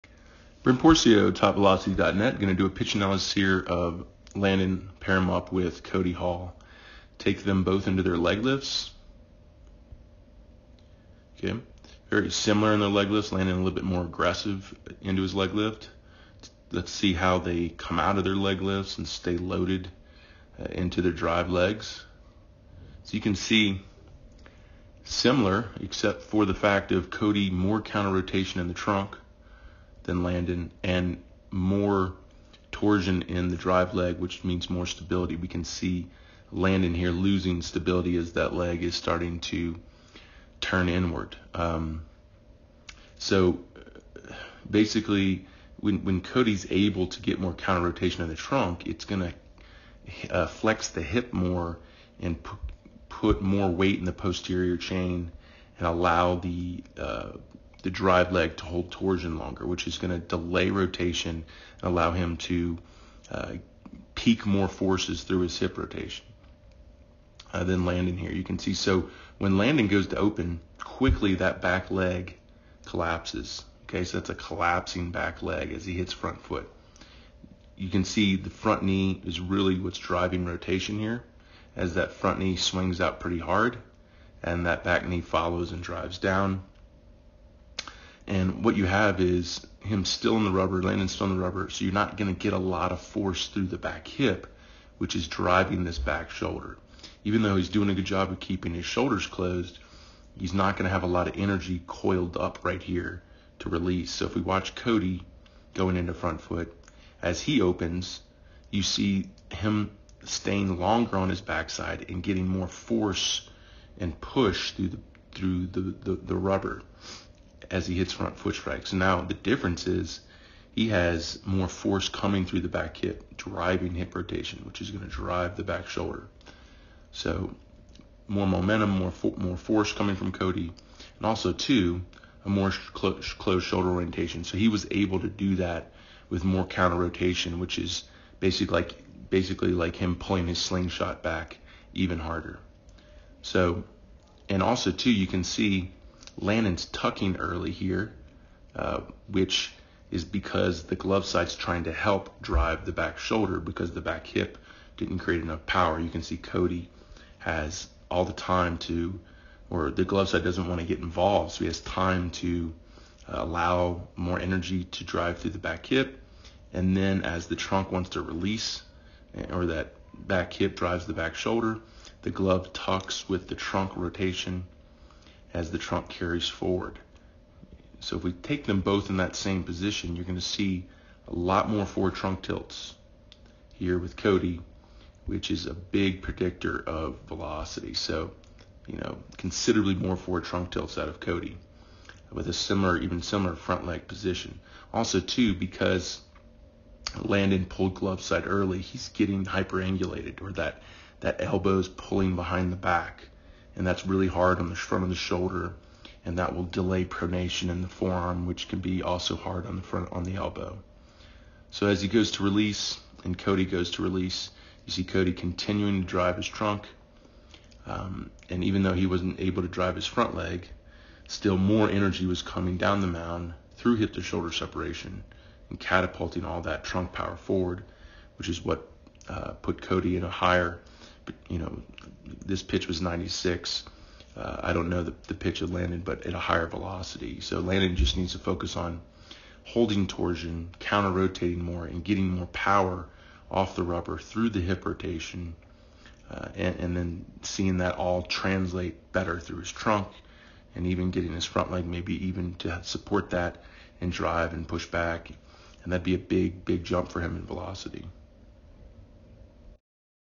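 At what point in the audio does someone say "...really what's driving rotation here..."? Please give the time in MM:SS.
01:19.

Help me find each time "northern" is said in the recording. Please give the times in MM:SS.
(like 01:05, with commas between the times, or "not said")
not said.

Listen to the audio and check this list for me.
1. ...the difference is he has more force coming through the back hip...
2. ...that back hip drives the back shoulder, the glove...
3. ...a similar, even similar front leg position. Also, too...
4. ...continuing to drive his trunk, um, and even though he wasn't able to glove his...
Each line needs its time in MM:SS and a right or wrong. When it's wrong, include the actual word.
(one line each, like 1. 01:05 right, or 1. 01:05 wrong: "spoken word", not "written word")
1. 01:59 right
2. 02:49 right
3. 03:12 right
4. 03:35 wrong: "drive", not "glove".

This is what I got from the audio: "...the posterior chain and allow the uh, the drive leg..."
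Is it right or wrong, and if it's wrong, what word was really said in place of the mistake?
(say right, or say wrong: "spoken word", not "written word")
right.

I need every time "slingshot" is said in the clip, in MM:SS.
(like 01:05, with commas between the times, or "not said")
02:20.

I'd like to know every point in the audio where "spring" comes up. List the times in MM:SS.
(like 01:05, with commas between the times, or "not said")
not said.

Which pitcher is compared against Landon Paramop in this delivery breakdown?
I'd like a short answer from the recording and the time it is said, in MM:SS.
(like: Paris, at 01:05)
Cody Hall, at 00:05.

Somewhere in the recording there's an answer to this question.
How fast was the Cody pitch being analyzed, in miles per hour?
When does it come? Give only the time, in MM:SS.
03:53.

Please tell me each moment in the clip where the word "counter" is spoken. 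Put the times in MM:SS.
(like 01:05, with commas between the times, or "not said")
00:27, 00:47, 02:16, 04:00.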